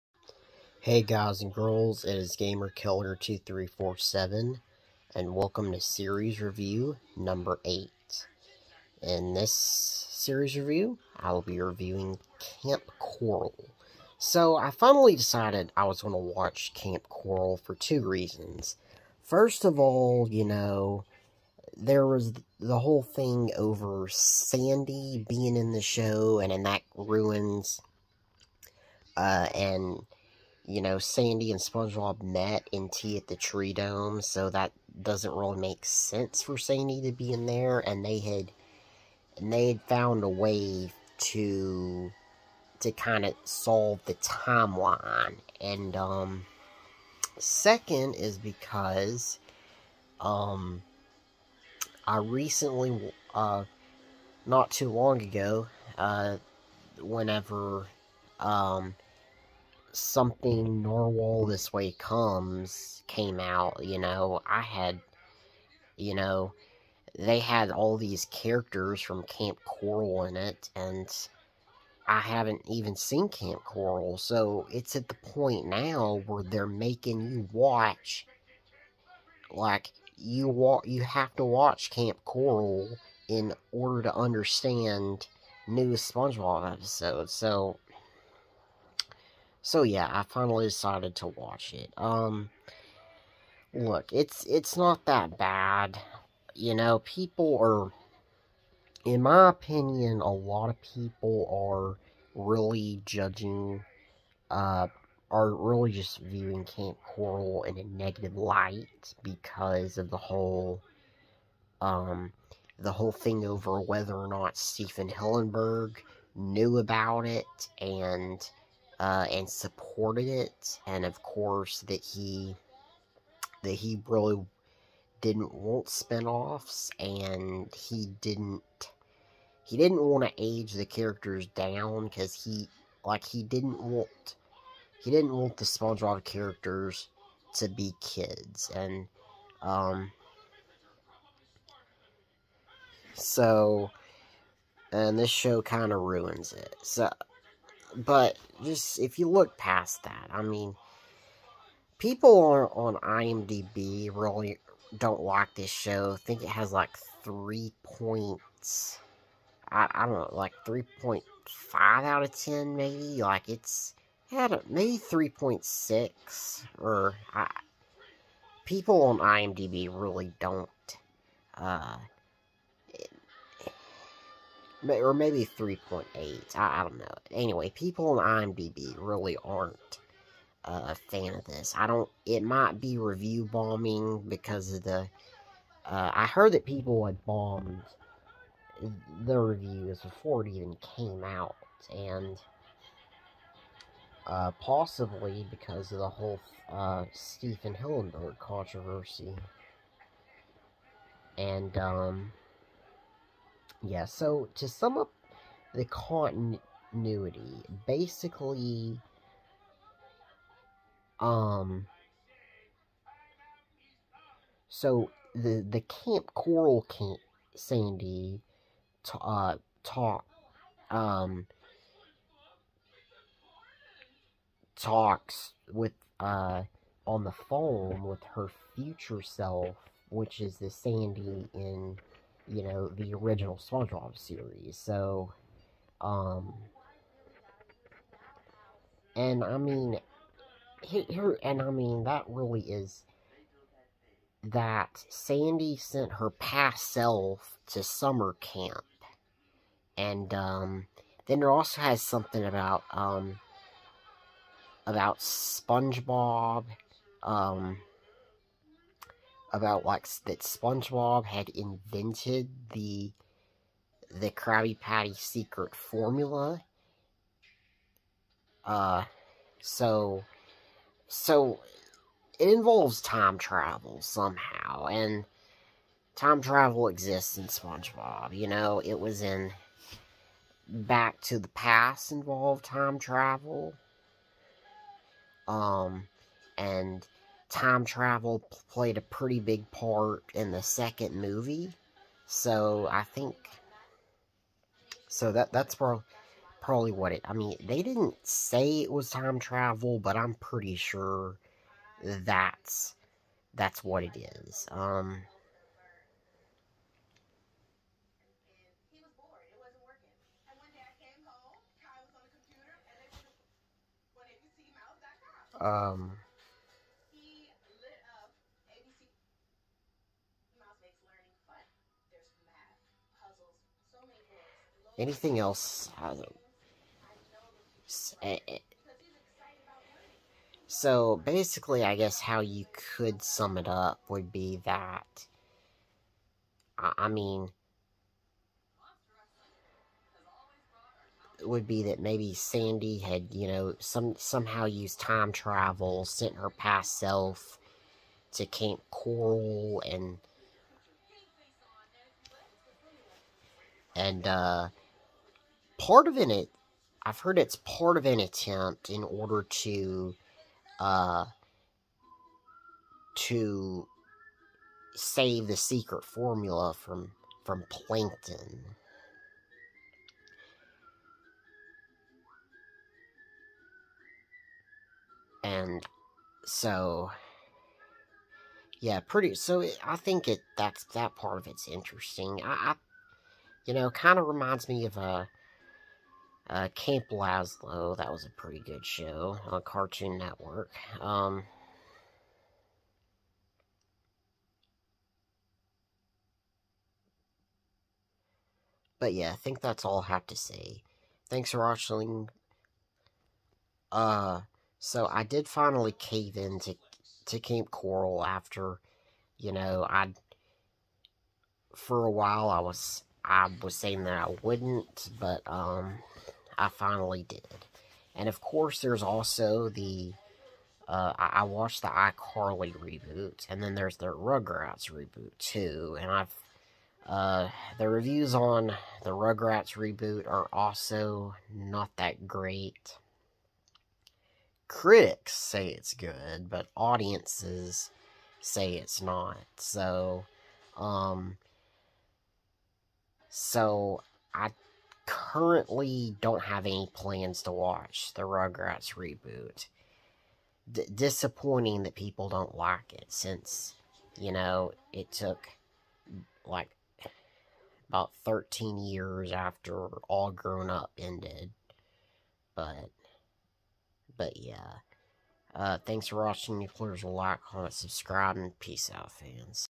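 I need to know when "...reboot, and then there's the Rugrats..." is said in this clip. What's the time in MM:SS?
07:02.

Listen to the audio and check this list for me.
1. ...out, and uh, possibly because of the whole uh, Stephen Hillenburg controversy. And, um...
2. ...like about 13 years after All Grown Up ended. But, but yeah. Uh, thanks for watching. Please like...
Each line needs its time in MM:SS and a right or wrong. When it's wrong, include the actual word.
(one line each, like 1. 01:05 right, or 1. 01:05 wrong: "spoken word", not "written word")
1. 03:11 right
2. 07:36 right.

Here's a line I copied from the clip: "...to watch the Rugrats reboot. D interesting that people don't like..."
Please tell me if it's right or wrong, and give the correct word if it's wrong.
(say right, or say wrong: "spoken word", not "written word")
wrong: "disappointing", not "interesting".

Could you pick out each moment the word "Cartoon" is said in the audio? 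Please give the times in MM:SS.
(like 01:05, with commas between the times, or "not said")
06:29.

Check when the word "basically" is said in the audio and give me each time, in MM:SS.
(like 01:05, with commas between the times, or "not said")
03:27, 05:31.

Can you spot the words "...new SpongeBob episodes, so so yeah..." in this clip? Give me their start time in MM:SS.
01:25.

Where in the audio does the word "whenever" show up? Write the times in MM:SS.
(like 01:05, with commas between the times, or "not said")
00:56.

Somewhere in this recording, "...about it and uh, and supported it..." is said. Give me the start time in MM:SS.
01:56.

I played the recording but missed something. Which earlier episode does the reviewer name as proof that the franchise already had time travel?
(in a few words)
Back to the Past.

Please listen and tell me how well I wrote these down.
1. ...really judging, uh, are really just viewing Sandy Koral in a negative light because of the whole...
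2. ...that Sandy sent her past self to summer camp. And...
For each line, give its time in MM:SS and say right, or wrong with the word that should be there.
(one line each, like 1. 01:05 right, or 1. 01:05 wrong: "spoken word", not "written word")
1. 01:42 wrong: "Kamp", not "Sandy"
2. 04:04 right.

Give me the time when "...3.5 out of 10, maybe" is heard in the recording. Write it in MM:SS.
02:40.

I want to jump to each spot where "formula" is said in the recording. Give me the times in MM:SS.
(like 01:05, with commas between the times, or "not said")
04:25, 06:06.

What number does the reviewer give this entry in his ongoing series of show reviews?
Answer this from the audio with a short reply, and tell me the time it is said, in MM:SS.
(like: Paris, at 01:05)
8, at 00:07.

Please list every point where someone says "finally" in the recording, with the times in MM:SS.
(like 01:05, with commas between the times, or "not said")
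00:14, 01:30, 06:45, 06:56.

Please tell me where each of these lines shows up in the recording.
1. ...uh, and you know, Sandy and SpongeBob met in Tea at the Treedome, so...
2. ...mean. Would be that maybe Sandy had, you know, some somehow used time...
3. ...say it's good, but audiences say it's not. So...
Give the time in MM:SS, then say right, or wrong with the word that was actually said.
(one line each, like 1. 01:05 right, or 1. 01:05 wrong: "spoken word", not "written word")
1. 00:29 right
2. 05:37 right
3. 07:15 right.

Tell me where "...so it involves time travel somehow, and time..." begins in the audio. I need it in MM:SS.
04:31.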